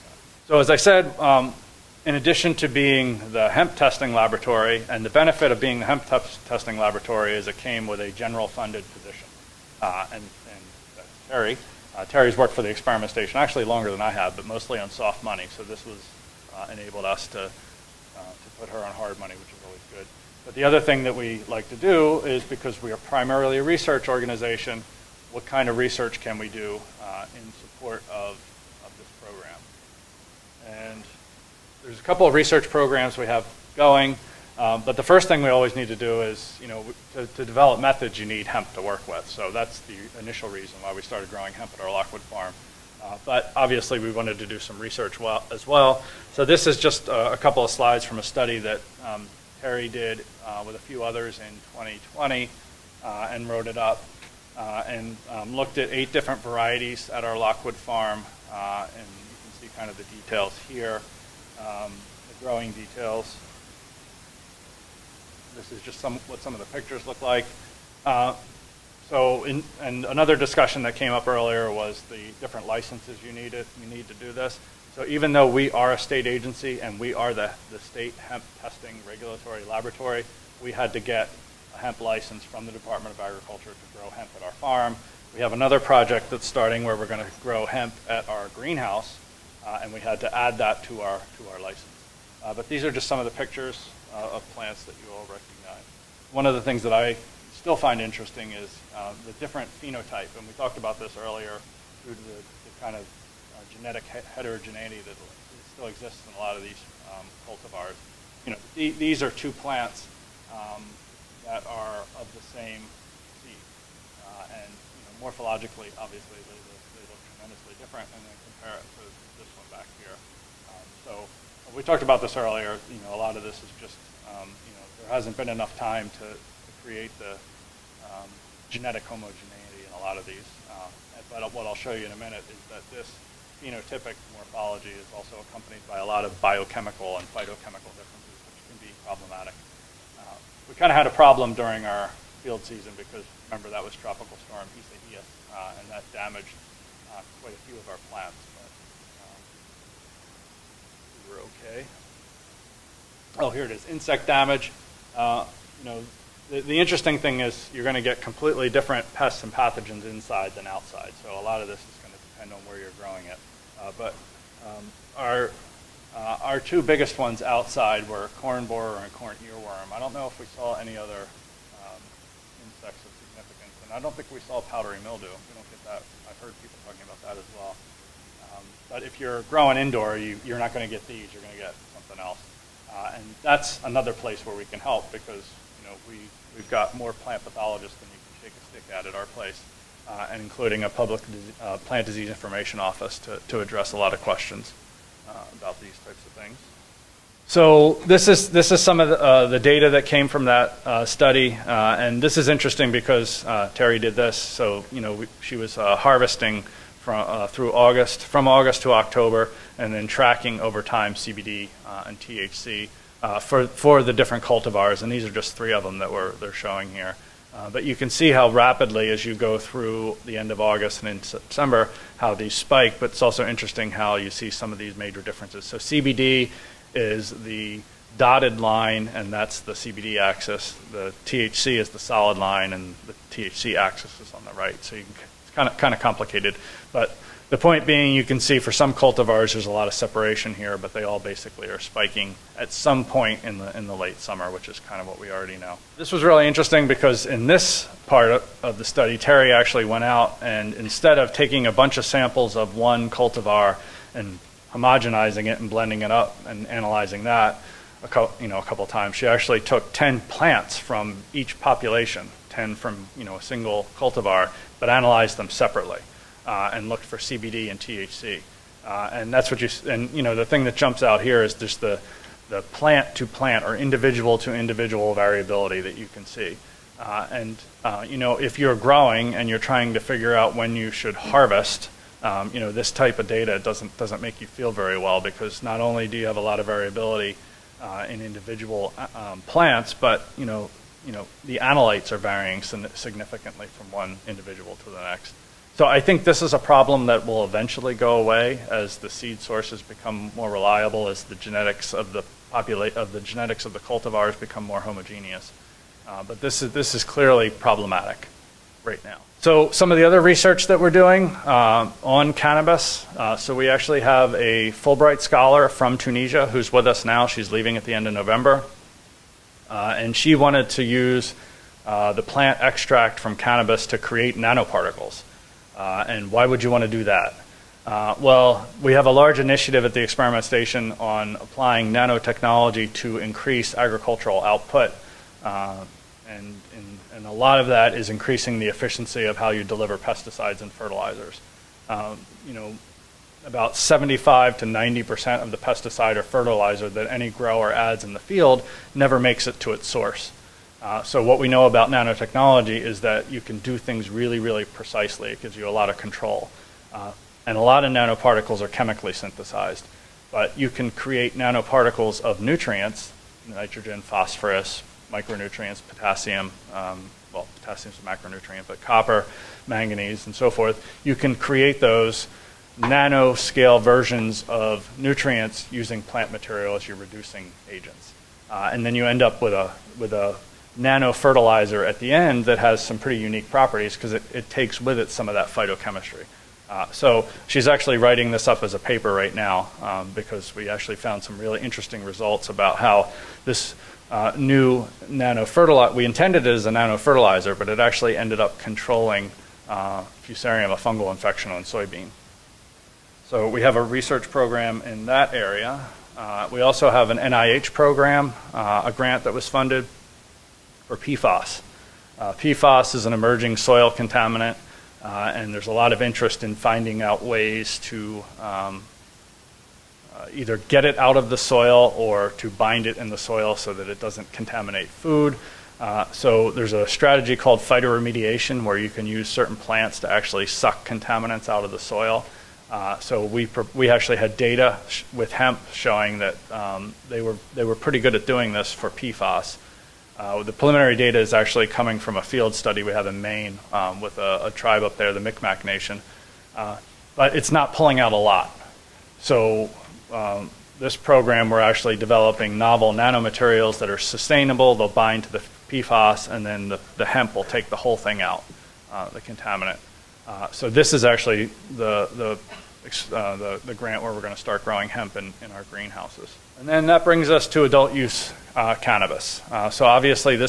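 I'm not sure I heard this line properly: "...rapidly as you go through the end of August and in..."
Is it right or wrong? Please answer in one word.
right.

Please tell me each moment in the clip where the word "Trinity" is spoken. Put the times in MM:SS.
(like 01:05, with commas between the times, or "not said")
not said.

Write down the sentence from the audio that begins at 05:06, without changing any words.
Uh, but this is this is clearly problematic right now.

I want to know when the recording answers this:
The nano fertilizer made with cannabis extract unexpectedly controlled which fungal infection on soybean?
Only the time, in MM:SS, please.
06:40.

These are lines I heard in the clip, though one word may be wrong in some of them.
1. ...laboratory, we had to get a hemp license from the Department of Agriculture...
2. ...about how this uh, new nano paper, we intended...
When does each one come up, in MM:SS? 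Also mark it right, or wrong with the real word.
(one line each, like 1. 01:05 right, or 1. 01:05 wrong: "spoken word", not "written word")
1. 01:19 right
2. 06:32 wrong: "fertilizer", not "paper".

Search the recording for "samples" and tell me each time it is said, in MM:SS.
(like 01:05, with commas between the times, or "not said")
04:12.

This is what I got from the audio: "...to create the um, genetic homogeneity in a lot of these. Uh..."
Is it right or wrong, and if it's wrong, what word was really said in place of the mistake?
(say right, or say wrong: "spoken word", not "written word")
right.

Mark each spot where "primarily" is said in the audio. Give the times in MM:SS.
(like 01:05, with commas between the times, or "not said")
00:22.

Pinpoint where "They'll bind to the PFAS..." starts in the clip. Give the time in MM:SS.
07:34.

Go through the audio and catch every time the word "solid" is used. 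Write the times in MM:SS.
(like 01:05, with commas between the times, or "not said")
03:51.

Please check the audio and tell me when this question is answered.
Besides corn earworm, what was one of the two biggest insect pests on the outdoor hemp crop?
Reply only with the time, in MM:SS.
02:48.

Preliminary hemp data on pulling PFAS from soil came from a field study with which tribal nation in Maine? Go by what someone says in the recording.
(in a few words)
Micmac Nation.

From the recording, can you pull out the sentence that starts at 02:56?
I've heard people talking about that as well.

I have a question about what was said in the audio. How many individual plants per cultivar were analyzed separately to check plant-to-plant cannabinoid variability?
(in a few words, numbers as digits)
10.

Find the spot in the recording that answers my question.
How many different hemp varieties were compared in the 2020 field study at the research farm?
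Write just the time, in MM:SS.
00:55.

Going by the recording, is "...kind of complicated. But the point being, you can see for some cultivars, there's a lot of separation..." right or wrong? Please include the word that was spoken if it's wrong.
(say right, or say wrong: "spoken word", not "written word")
right.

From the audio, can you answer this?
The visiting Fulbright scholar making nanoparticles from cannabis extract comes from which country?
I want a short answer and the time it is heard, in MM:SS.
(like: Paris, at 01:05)
Tunisia, at 05:15.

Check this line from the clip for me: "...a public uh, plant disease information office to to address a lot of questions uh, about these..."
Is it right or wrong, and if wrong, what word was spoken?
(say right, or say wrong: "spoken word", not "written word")
right.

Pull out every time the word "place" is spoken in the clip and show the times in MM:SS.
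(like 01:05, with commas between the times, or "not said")
03:04, 03:09.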